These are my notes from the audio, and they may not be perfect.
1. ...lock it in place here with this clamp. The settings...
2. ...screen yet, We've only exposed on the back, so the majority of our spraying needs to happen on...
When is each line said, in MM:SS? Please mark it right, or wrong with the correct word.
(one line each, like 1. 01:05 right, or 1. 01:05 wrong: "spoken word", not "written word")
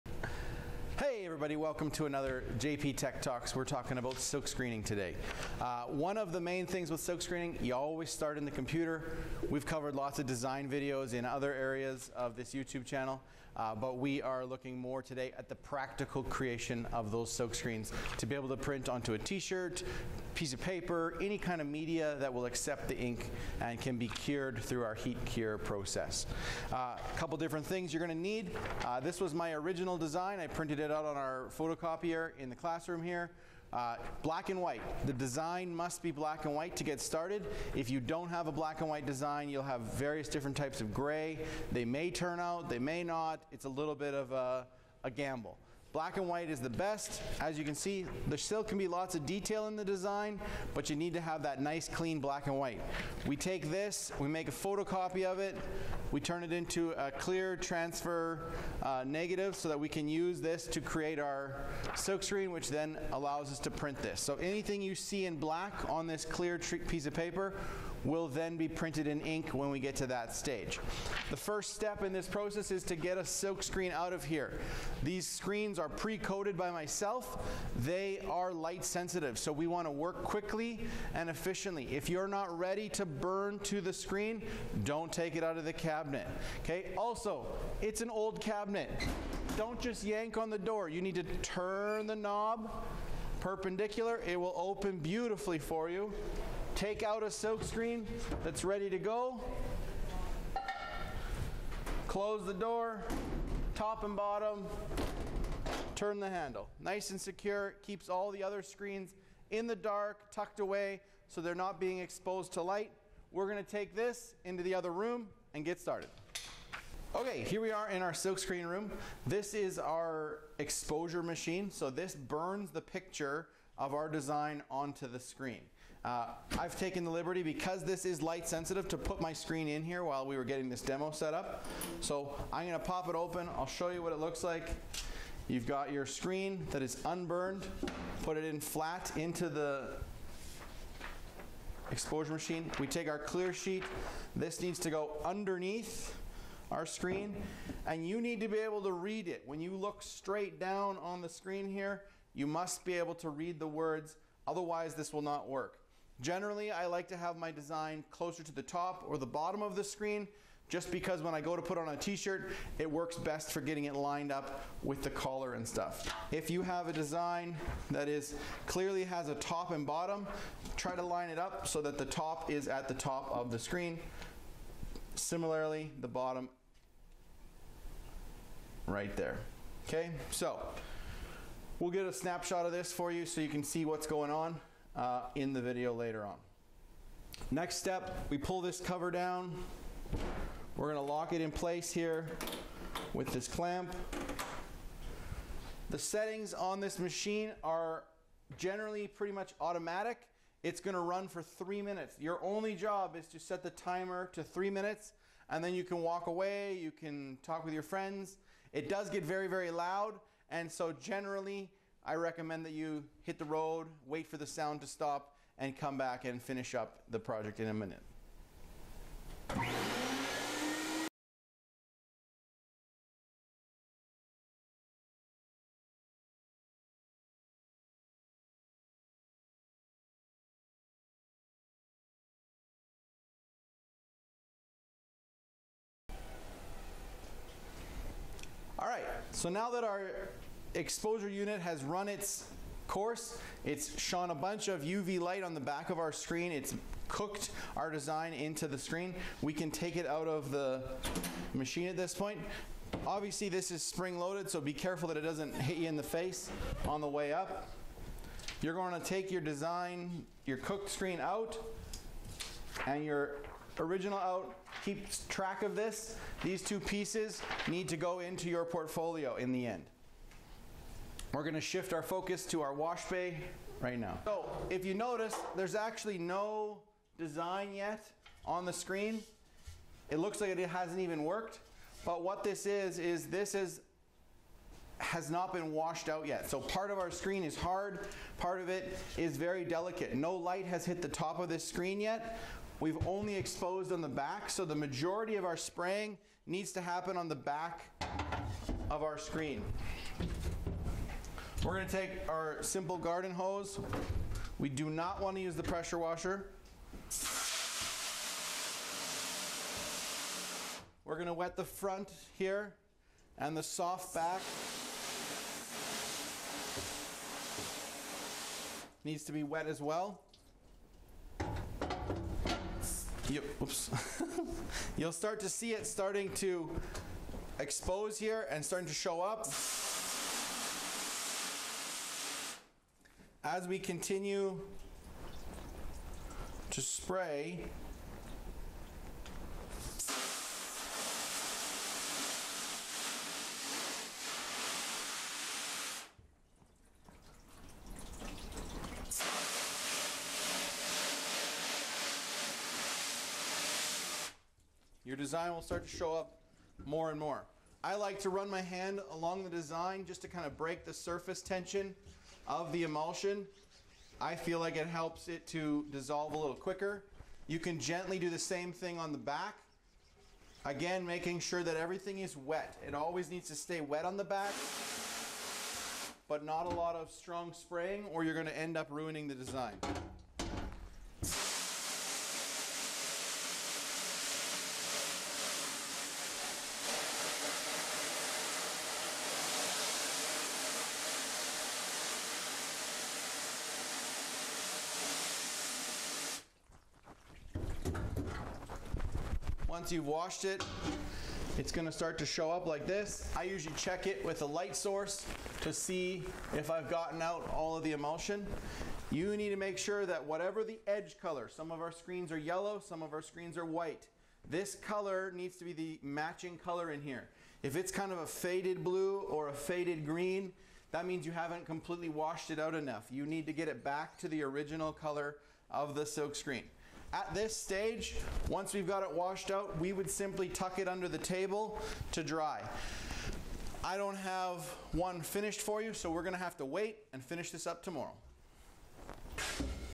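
1. 03:11 right
2. 04:51 right.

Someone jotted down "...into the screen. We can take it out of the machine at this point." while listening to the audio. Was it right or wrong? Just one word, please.
right.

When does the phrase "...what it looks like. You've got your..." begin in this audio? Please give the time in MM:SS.
02:14.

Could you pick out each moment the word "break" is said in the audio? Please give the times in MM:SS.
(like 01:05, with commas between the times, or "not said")
06:00.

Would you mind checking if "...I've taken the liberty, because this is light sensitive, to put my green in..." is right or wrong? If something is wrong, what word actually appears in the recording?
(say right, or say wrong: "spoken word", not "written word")
wrong: "screen", not "green".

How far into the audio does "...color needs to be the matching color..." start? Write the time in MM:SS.
06:54.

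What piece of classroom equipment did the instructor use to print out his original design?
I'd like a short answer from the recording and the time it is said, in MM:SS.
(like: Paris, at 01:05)
photocopier, at 00:31.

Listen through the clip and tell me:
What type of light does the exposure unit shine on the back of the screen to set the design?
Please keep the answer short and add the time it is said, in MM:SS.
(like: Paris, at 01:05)
UV light, at 04:04.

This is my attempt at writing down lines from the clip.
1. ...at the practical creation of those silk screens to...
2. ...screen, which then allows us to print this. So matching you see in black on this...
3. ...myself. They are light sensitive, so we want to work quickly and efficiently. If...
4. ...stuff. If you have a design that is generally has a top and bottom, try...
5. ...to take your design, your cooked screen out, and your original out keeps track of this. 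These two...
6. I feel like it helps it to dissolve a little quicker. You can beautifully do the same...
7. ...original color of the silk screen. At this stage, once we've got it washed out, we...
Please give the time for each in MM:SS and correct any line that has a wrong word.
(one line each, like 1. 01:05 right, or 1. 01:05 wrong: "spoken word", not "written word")
1. 00:15 right
2. 01:02 wrong: "anything", not "matching"
3. 01:16 right
4. 02:45 wrong: "clearly", not "generally"
5. 04:18 right
6. 06:04 wrong: "gently", not "beautifully"
7. 07:04 right.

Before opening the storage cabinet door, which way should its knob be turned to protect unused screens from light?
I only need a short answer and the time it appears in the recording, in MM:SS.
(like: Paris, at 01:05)
perpendicular, at 01:33.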